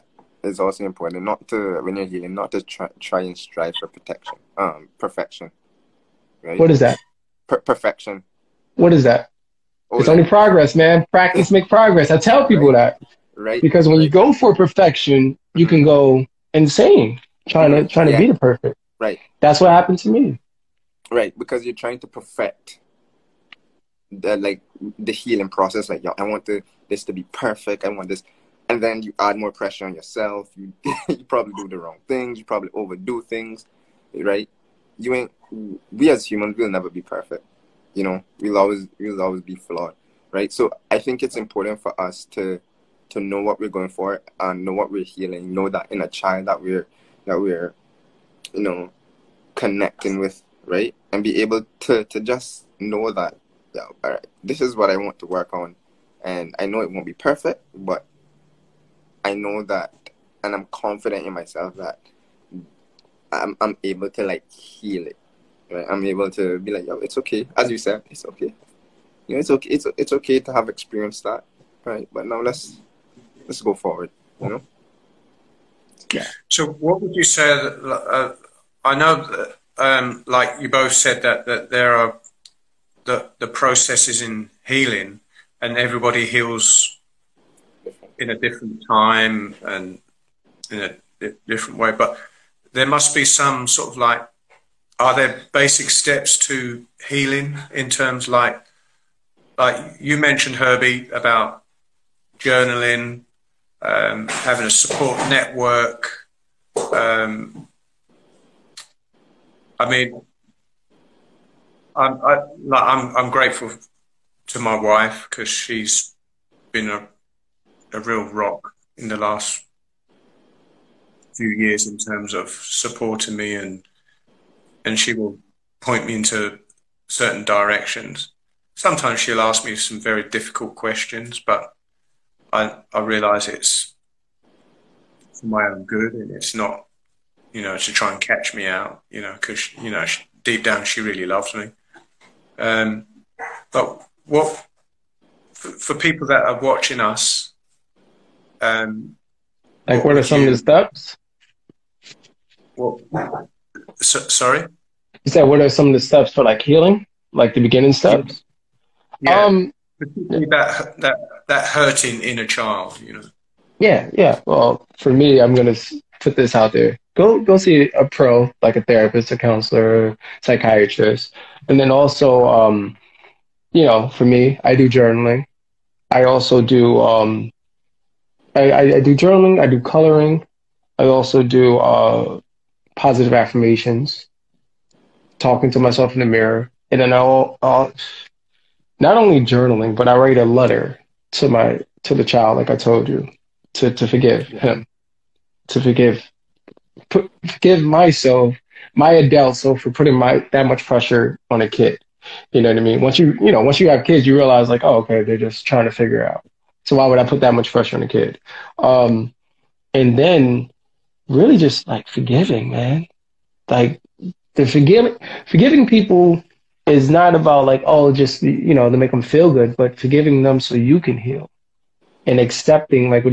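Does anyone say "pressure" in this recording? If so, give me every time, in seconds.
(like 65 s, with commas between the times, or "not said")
29 s, 200 s, 207 s.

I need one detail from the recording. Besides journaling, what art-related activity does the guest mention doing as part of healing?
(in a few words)
Coloring.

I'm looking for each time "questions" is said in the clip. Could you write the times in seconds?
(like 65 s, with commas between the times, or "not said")
130 s.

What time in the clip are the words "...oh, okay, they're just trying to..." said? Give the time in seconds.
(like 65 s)
204 s.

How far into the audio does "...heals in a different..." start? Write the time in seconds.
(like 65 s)
86 s.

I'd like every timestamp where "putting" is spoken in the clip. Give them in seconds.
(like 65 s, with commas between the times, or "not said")
199 s.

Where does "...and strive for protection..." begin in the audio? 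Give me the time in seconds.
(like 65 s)
3 s.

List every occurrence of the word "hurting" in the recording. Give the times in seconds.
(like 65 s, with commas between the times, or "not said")
161 s.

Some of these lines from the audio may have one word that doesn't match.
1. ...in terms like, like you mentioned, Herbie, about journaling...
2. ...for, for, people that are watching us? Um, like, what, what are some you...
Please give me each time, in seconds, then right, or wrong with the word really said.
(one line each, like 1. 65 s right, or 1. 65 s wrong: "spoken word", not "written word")
1. 97 s right
2. 145 s right.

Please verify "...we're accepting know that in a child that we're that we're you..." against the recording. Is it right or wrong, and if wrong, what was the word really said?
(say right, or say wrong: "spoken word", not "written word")
wrong: "healing", not "accepting".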